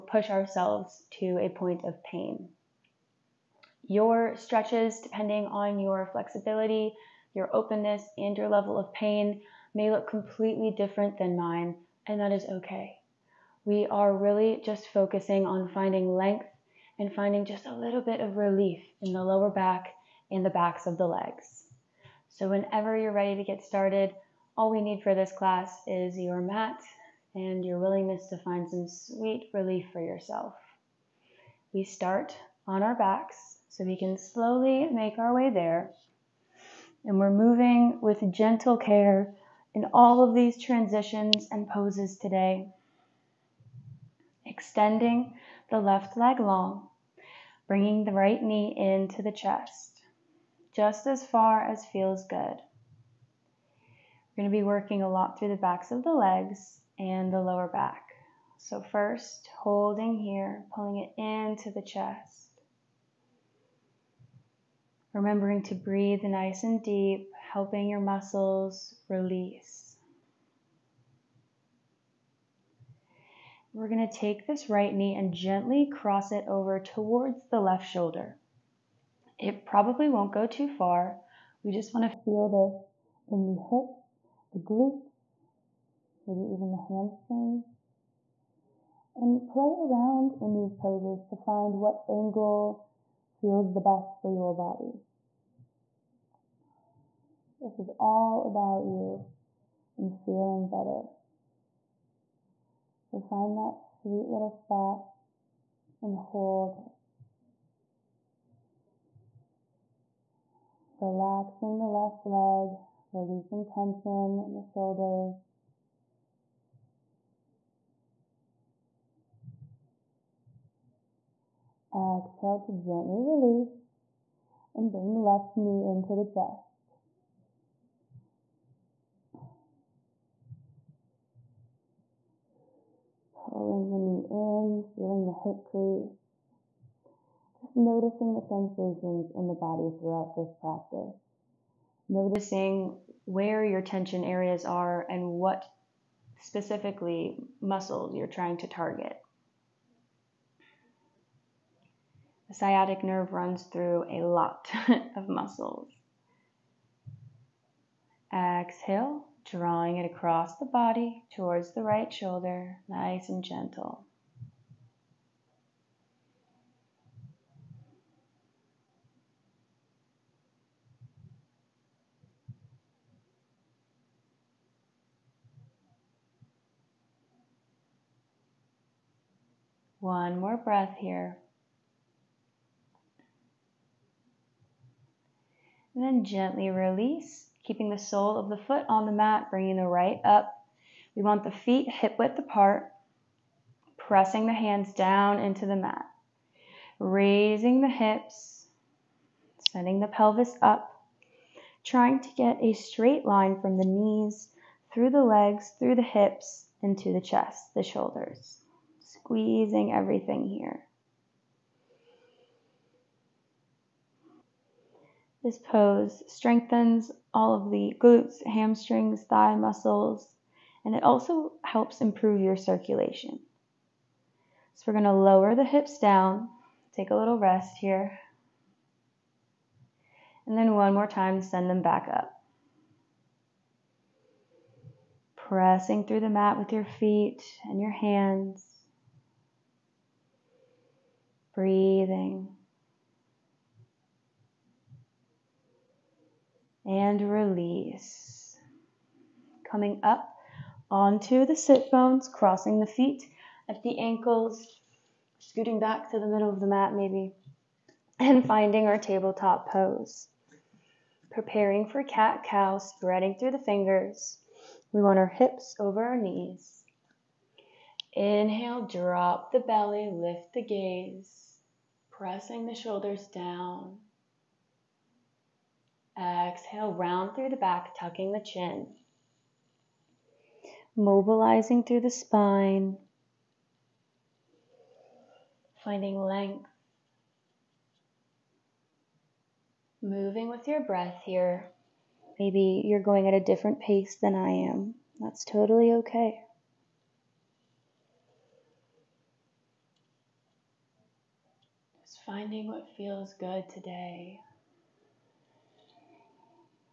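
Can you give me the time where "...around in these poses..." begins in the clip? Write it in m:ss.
1:29.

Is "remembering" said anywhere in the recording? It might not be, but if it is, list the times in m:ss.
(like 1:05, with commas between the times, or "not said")
1:05.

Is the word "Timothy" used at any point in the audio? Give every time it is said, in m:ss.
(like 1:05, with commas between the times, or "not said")
not said.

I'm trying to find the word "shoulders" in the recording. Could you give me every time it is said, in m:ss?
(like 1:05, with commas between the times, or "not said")
1:17, 1:54, 2:42, 3:27, 4:32.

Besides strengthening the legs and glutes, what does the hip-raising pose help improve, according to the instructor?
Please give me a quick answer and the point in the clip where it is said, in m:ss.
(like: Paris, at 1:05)
Circulation, at 3:42.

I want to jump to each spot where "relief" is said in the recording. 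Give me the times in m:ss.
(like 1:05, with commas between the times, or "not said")
0:18, 0:29.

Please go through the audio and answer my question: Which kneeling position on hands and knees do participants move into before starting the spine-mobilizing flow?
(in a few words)
Tabletop pose.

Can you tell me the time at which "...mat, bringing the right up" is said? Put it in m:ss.
3:09.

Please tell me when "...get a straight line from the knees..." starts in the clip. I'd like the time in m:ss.
3:22.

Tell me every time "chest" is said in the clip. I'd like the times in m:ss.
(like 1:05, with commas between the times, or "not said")
0:49, 1:01, 2:06, 3:27.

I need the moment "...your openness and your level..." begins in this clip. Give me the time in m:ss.
0:07.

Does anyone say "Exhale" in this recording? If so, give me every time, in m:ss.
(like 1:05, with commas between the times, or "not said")
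2:01, 2:38, 4:36.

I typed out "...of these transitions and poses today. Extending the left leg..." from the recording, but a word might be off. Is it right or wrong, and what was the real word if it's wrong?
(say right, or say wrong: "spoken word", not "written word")
right.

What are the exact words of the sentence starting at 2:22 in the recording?
Noticing where your tension areas are and what specifically muscles you're trying to target.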